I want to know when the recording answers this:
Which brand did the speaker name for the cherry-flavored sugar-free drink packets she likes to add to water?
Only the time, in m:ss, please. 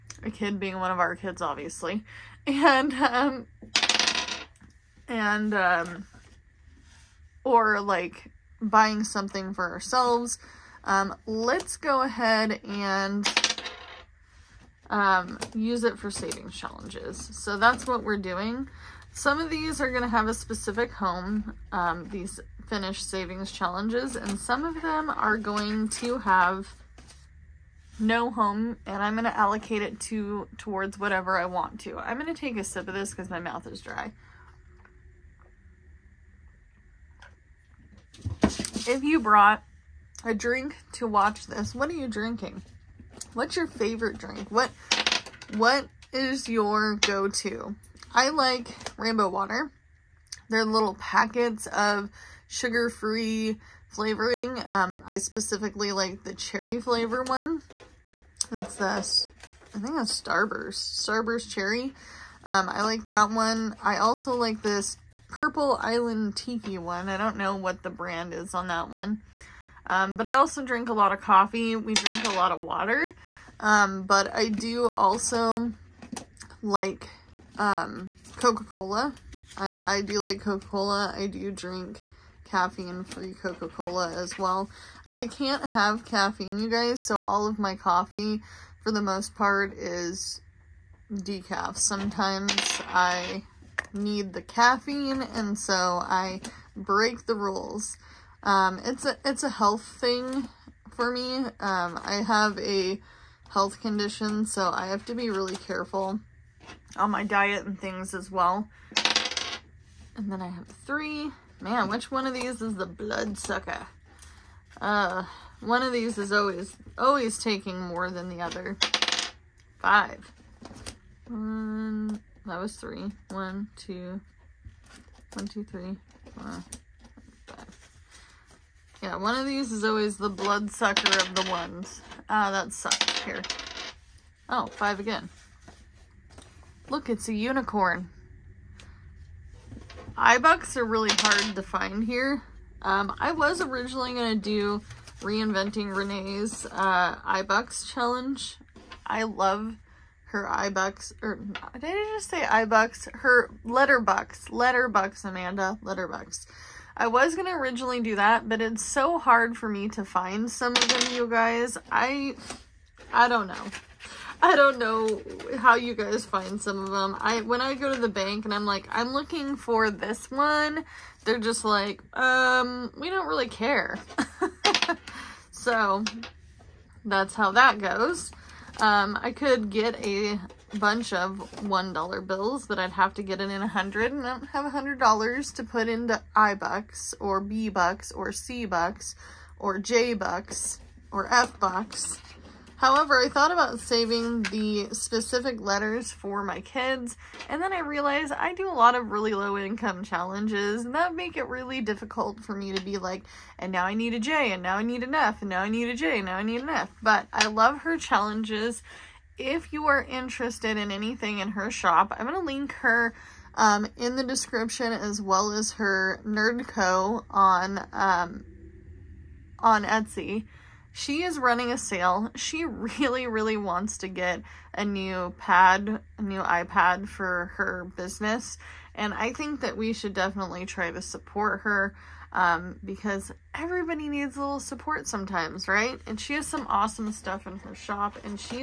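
1:01.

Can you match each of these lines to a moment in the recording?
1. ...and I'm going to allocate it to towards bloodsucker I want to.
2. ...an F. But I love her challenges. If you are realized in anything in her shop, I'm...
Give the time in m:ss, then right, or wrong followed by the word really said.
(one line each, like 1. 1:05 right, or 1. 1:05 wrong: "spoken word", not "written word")
1. 0:28 wrong: "whatever", not "bloodsucker"
2. 3:26 wrong: "interested", not "realized".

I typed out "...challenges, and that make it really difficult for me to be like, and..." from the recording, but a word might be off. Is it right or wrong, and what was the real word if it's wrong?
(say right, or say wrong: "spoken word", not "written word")
right.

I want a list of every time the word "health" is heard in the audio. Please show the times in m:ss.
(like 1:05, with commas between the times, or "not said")
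1:39, 1:43.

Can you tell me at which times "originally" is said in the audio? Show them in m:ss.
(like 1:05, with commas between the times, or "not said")
2:23, 2:37.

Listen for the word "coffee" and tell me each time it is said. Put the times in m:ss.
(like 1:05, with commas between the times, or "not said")
1:11, 1:27.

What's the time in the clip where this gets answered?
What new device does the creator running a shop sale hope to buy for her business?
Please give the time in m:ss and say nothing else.
3:46.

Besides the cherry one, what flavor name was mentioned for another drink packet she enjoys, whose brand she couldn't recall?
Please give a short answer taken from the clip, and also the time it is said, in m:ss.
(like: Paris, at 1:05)
Purple Island Tiki, at 1:05.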